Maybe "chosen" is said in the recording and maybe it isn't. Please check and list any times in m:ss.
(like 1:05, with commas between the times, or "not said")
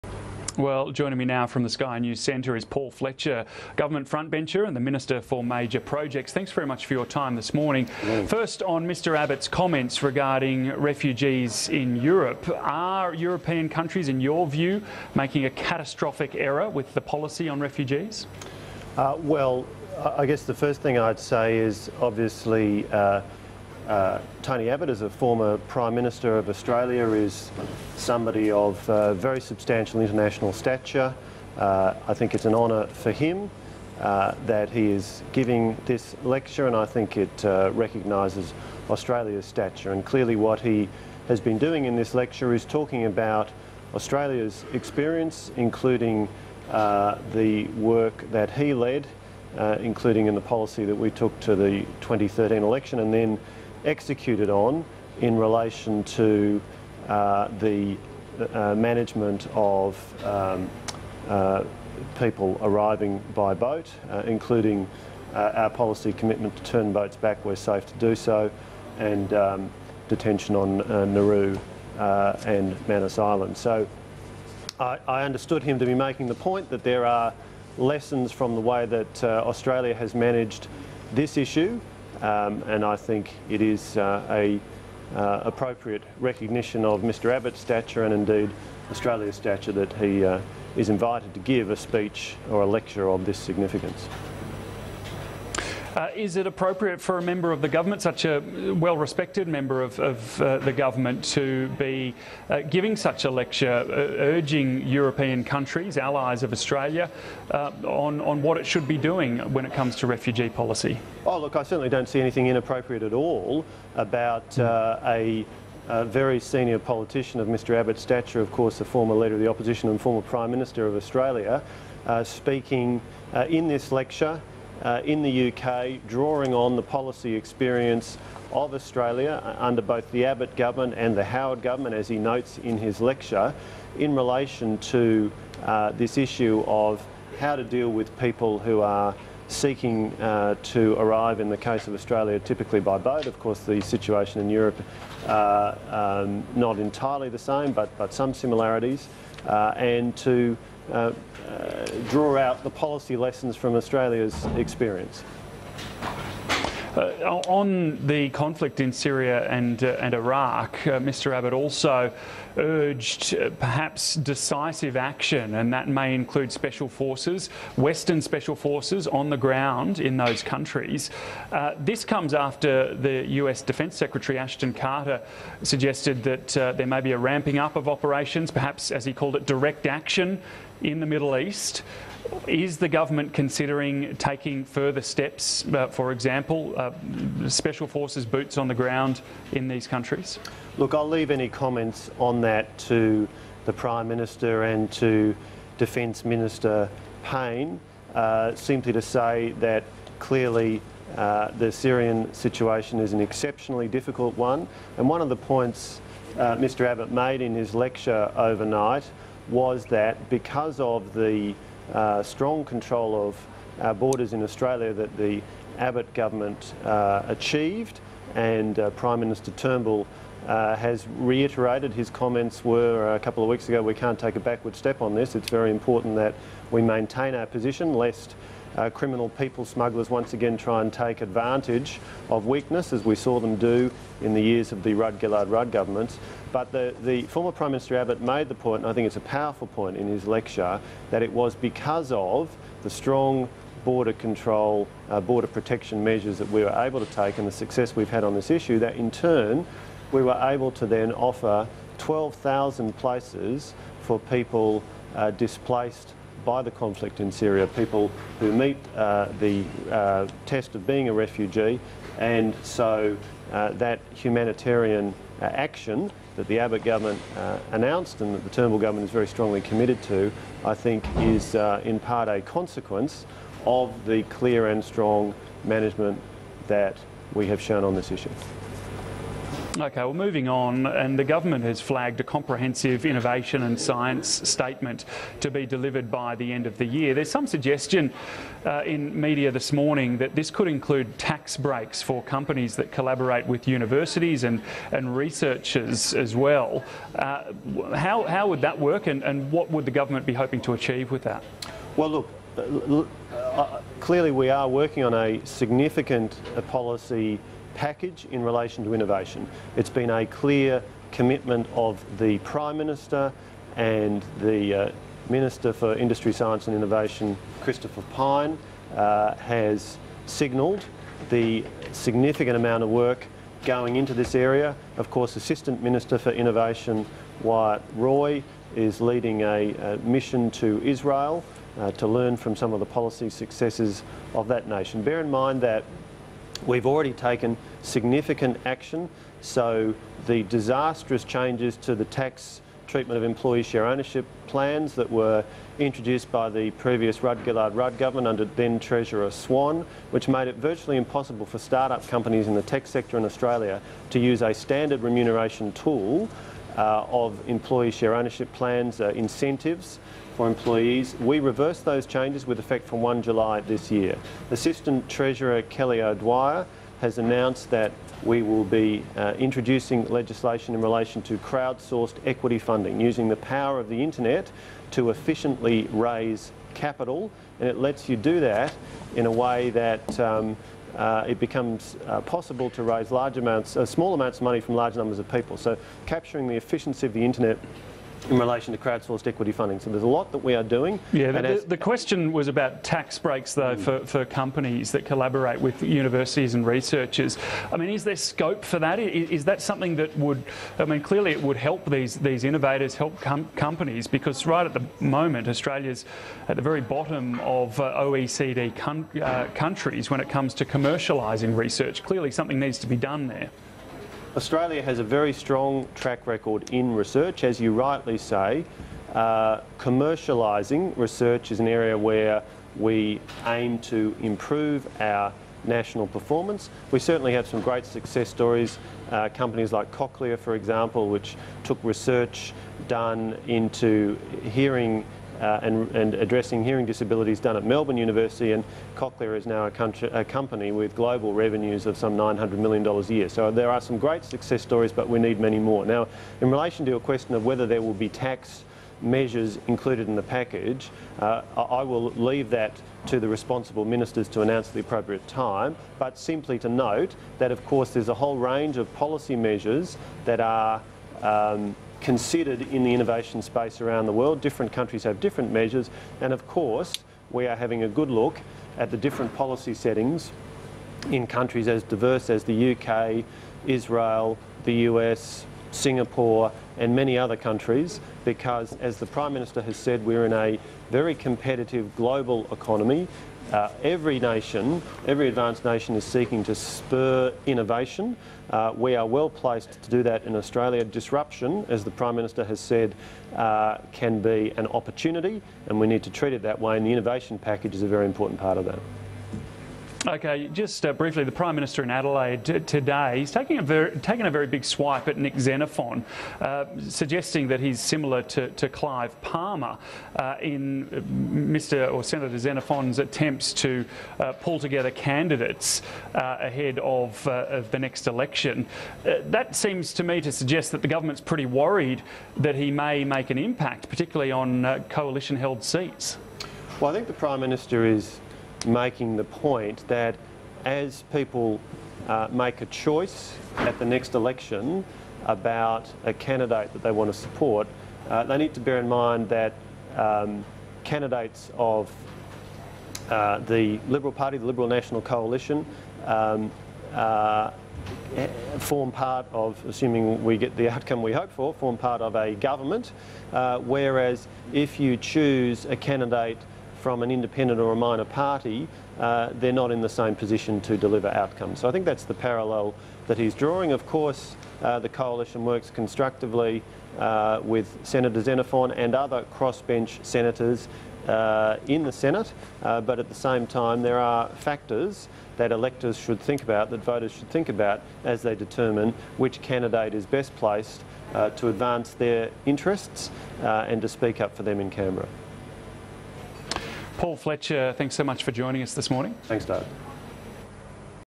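not said.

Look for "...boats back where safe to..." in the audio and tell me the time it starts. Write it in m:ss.
1:06.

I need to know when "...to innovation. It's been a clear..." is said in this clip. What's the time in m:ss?
5:08.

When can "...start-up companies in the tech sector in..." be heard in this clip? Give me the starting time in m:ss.
5:51.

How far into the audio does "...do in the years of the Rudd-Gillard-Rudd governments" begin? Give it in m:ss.
3:53.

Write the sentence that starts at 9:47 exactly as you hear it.
Paul Fletcher, thanks so much for joining us this morning.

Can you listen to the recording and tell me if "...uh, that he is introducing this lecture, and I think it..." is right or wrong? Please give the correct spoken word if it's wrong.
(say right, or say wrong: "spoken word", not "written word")
wrong: "giving", not "introducing".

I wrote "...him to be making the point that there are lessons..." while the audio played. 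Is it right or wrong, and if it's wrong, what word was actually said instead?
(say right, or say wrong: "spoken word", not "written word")
right.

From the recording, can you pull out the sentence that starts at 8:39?
that seems to me to suggest that the government's pretty worried that he may make an impact, particularly on coalition held seats.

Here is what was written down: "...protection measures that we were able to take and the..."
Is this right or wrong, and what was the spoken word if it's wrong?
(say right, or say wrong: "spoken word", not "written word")
right.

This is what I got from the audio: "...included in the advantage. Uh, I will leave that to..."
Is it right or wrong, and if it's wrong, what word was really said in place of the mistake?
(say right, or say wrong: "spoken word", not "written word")
wrong: "package", not "advantage".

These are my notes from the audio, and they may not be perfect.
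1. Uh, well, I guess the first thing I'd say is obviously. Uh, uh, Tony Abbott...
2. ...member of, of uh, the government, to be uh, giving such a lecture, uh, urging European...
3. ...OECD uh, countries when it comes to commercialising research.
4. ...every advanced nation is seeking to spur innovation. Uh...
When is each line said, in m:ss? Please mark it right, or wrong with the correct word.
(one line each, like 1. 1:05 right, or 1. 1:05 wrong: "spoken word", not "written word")
1. 0:18 right
2. 1:39 right
3. 6:48 right
4. 8:05 right.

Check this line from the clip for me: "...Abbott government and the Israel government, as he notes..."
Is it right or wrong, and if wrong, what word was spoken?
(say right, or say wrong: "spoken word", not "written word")
wrong: "Howard", not "Israel".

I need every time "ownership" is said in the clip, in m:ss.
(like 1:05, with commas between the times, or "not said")
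5:43, 5:58.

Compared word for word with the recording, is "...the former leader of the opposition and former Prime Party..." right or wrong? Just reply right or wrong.
wrong.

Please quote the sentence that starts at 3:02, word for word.
Is the government considering taking further steps, uh, for example, uh, special forces boots on the ground in these countries?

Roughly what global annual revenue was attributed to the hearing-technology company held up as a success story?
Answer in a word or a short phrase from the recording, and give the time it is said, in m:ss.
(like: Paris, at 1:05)
$900 million, at 7:22.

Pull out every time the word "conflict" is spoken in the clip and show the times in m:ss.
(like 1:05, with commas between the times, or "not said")
2:38, 4:16.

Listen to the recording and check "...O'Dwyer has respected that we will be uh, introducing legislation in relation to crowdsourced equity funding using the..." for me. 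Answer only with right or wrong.
wrong.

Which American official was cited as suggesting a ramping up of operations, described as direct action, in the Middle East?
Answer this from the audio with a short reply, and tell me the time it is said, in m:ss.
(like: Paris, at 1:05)
Ashton Carter, at 2:54.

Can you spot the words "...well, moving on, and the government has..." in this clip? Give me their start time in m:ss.
4:40.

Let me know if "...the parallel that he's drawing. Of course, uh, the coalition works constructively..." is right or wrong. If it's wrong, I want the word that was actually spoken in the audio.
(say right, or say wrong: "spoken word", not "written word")
right.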